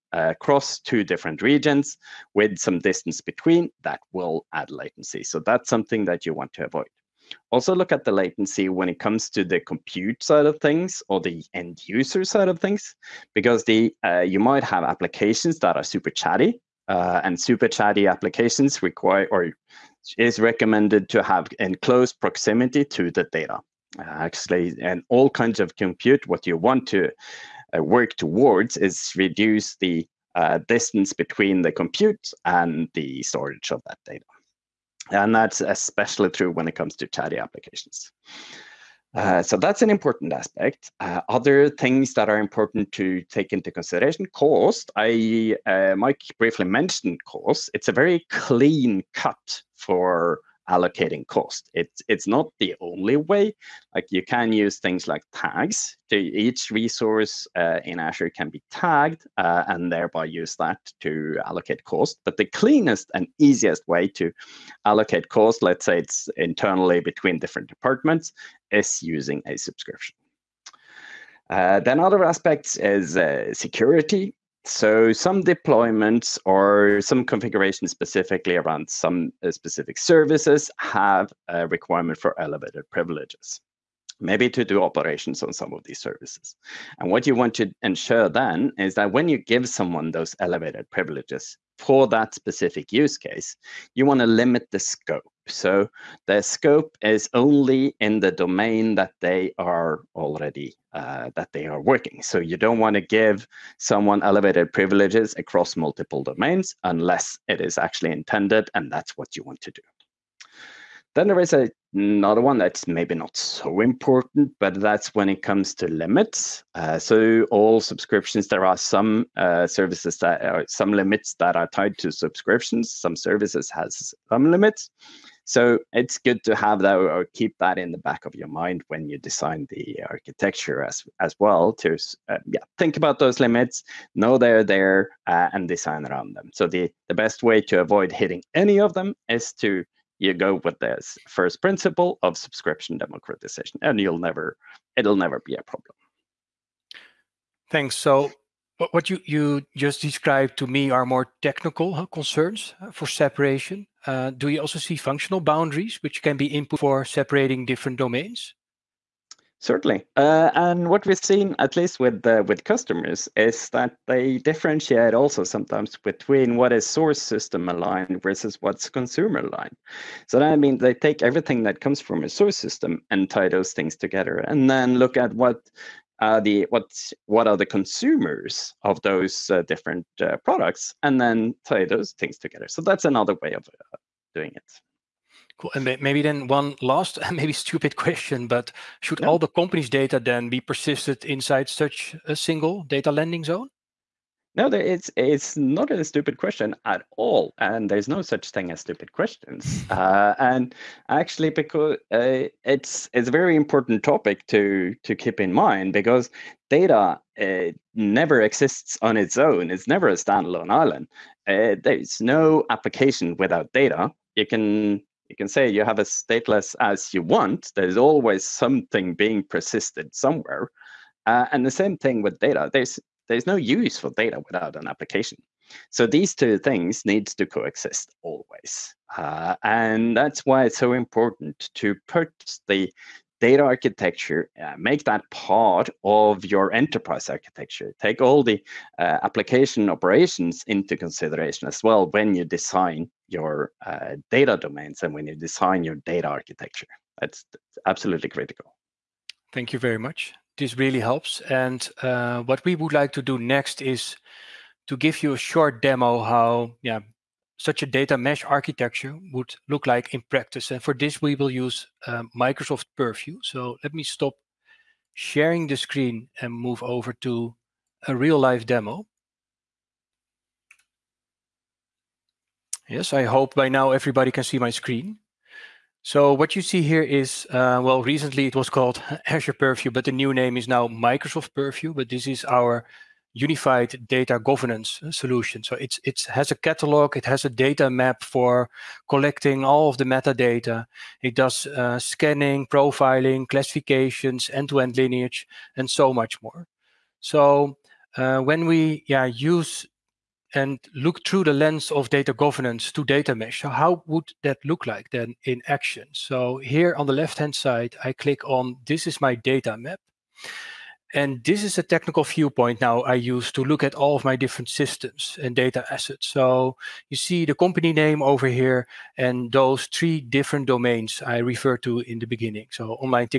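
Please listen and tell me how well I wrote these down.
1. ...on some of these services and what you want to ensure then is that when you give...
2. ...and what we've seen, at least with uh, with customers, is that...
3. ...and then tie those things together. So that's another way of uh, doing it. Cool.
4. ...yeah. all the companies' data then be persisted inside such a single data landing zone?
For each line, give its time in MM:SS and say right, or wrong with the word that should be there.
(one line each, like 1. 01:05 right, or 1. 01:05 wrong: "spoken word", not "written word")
1. 01:25 right
2. 02:40 right
3. 03:01 right
4. 03:09 right.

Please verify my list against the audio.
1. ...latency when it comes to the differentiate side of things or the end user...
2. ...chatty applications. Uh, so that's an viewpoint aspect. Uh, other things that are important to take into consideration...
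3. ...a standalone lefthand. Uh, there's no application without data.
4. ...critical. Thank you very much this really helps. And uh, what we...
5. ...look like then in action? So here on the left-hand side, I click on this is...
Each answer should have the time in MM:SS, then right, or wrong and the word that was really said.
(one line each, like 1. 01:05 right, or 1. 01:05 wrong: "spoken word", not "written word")
1. 00:08 wrong: "compute", not "differentiate"
2. 00:37 wrong: "important", not "viewpoint"
3. 03:30 wrong: "island", not "lefthand"
4. 04:08 right
5. 05:04 right.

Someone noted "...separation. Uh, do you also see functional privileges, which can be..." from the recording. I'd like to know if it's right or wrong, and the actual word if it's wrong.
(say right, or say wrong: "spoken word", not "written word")
wrong: "boundaries", not "privileges".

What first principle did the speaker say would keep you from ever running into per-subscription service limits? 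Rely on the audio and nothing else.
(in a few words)
Subscription democratization.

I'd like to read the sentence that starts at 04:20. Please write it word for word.
And for this, we will use uh, Microsoft Purview.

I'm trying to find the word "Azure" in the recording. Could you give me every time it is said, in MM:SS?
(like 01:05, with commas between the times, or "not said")
00:57, 04:39.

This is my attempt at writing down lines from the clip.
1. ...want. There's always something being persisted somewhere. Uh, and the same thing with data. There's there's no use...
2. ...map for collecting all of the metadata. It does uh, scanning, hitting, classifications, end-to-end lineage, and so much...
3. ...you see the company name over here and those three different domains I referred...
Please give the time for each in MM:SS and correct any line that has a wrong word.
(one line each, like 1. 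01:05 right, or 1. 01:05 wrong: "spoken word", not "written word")
1. 03:37 right
2. 04:47 wrong: "profiling", not "hitting"
3. 05:17 right.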